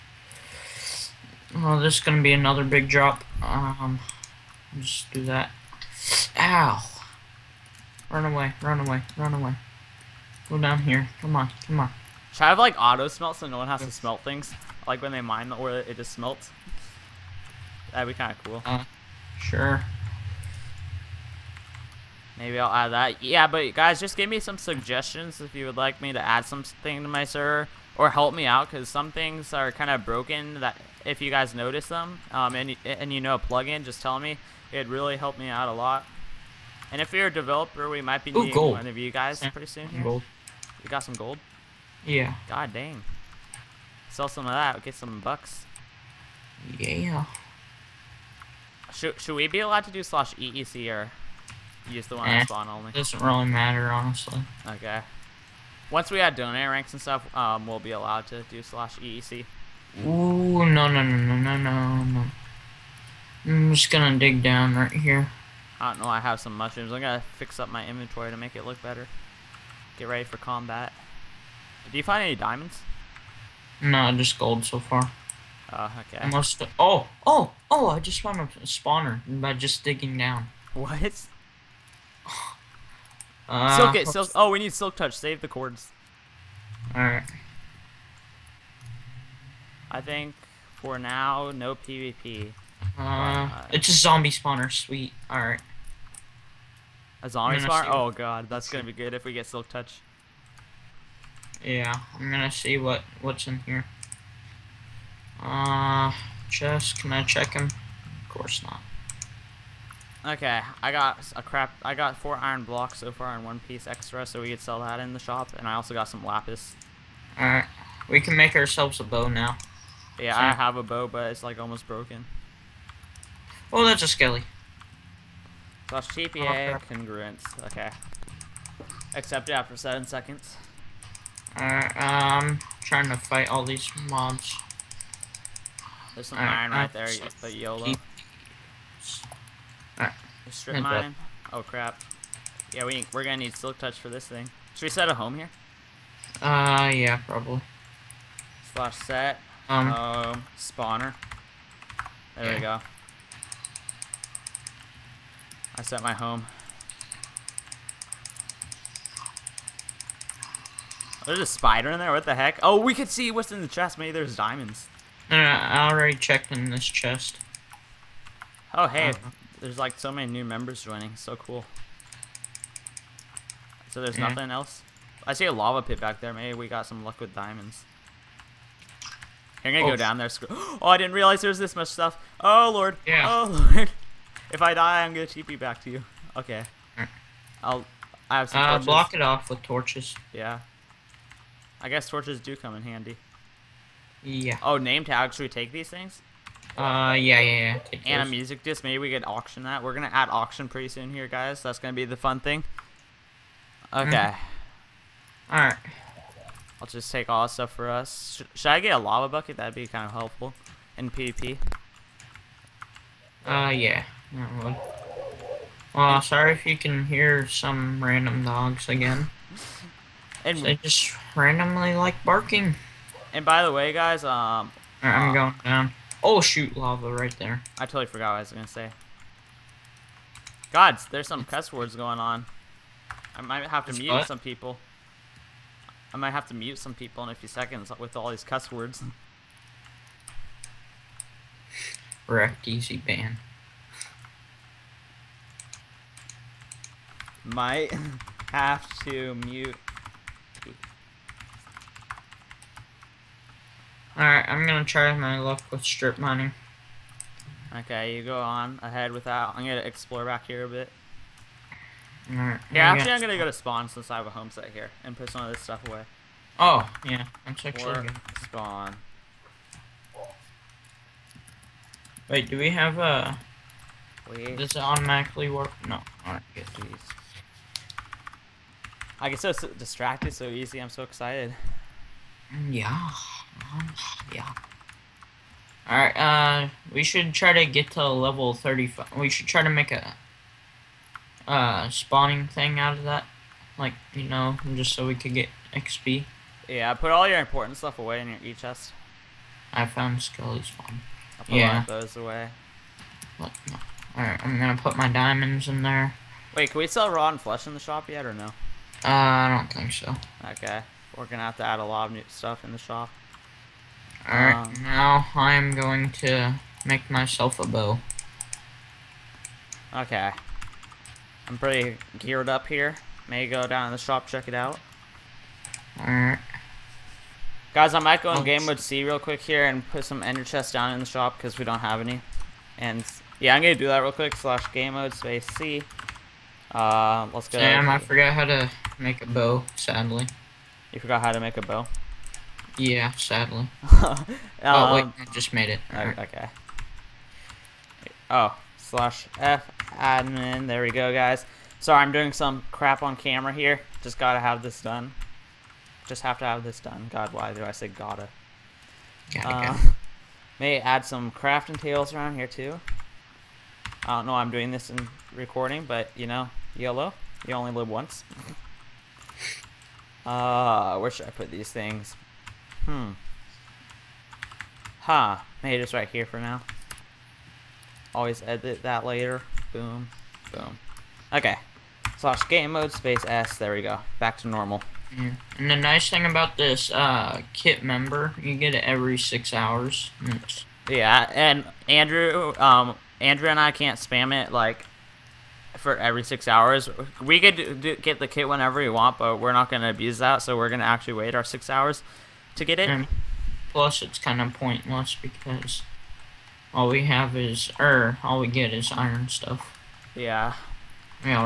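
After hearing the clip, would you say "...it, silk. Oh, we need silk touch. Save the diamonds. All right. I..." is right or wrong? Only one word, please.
wrong.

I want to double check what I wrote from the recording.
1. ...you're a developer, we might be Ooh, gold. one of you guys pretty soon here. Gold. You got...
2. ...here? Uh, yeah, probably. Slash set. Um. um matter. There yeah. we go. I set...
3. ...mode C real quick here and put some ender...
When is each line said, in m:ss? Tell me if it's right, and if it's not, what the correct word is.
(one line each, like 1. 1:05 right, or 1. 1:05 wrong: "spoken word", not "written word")
1. 0:37 right
2. 2:25 wrong: "spawner", not "matter"
3. 5:28 right.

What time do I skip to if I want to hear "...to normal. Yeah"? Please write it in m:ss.
6:24.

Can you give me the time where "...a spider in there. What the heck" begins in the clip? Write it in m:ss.
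2:41.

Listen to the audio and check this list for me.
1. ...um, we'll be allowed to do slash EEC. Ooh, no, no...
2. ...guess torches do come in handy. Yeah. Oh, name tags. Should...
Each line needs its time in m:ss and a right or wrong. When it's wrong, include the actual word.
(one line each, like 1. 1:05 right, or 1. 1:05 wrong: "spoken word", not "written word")
1. 0:57 right
2. 3:11 right.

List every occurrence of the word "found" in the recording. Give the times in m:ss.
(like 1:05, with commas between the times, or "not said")
1:18, 4:59.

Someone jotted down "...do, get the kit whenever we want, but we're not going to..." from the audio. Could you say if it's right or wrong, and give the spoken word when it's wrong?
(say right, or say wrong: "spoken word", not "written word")
right.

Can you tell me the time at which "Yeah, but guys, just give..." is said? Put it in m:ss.
0:23.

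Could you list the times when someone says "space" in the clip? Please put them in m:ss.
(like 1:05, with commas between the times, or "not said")
5:35, 6:22.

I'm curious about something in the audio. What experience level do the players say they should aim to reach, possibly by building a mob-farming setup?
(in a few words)
35.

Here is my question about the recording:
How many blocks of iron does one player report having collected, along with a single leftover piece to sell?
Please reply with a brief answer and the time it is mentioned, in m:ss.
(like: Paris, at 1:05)
4, at 1:52.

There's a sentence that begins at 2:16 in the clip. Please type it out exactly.
There's some all iron right, right there, but YOLO.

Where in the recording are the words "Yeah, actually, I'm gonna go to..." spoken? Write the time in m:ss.
4:22.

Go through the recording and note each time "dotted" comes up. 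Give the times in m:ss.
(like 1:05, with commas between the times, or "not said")
not said.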